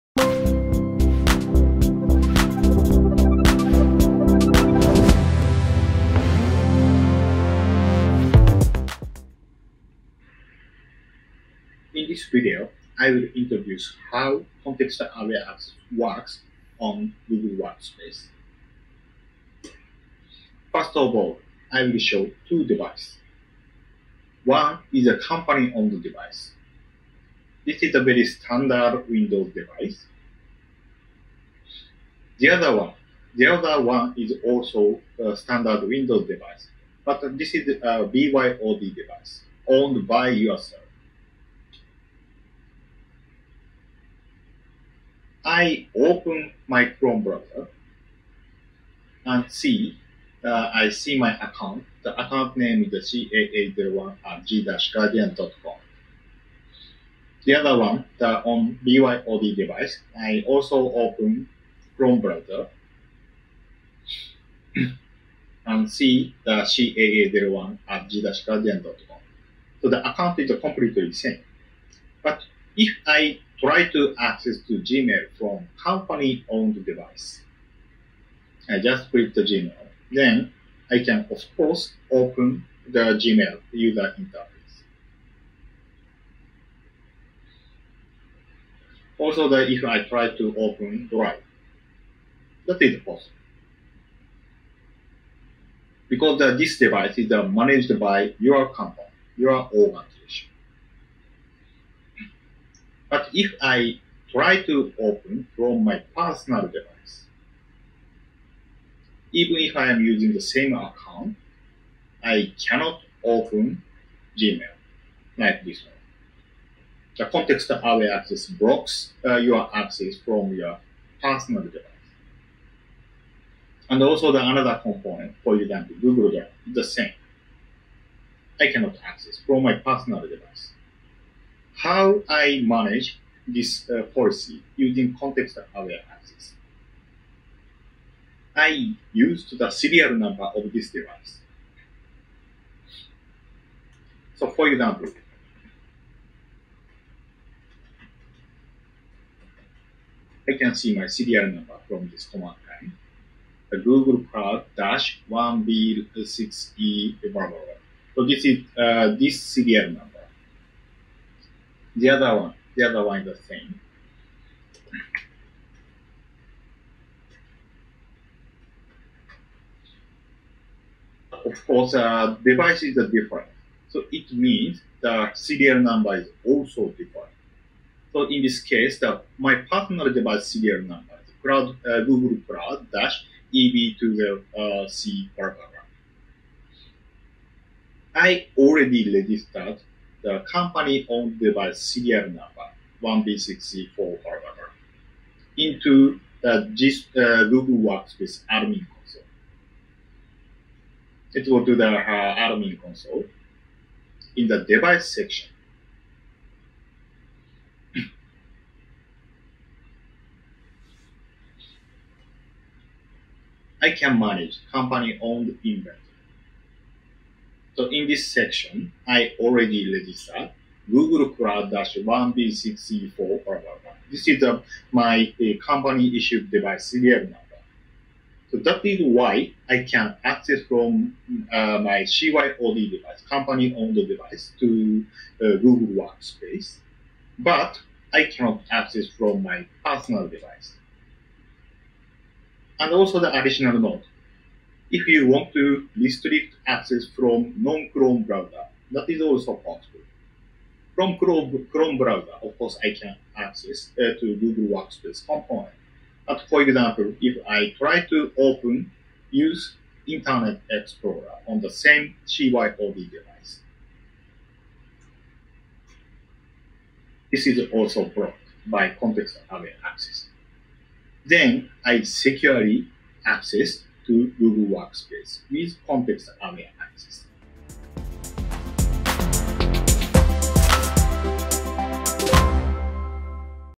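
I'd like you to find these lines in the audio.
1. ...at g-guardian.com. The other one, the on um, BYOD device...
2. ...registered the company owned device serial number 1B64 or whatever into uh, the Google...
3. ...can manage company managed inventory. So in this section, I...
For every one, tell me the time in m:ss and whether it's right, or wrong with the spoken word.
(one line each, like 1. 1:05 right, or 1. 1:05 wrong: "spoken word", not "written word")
1. 0:54 right
2. 3:09 wrong: "GIS", not "Google"
3. 3:33 wrong: "owned", not "managed".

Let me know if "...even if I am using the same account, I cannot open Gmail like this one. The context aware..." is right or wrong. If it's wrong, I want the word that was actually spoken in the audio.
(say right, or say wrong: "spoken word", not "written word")
right.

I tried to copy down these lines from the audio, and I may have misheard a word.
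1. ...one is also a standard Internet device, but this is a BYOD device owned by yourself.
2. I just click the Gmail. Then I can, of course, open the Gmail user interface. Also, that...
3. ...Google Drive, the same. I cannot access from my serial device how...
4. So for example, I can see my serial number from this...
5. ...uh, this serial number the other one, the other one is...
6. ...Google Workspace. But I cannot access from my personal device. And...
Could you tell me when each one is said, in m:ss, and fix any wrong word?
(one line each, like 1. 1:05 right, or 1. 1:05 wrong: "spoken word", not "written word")
1. 0:33 wrong: "Windows", not "Internet"
2. 1:18 right
3. 2:05 wrong: "personal", not "serial"
4. 2:24 right
5. 2:38 right
6. 3:55 right.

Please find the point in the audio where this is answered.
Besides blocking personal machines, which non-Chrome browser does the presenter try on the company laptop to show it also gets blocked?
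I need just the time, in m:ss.
4:20.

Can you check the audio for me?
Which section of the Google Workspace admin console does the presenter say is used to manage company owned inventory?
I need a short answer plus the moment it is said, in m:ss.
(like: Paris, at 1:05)
device section, at 3:24.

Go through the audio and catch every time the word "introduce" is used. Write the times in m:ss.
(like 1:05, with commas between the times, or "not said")
0:13.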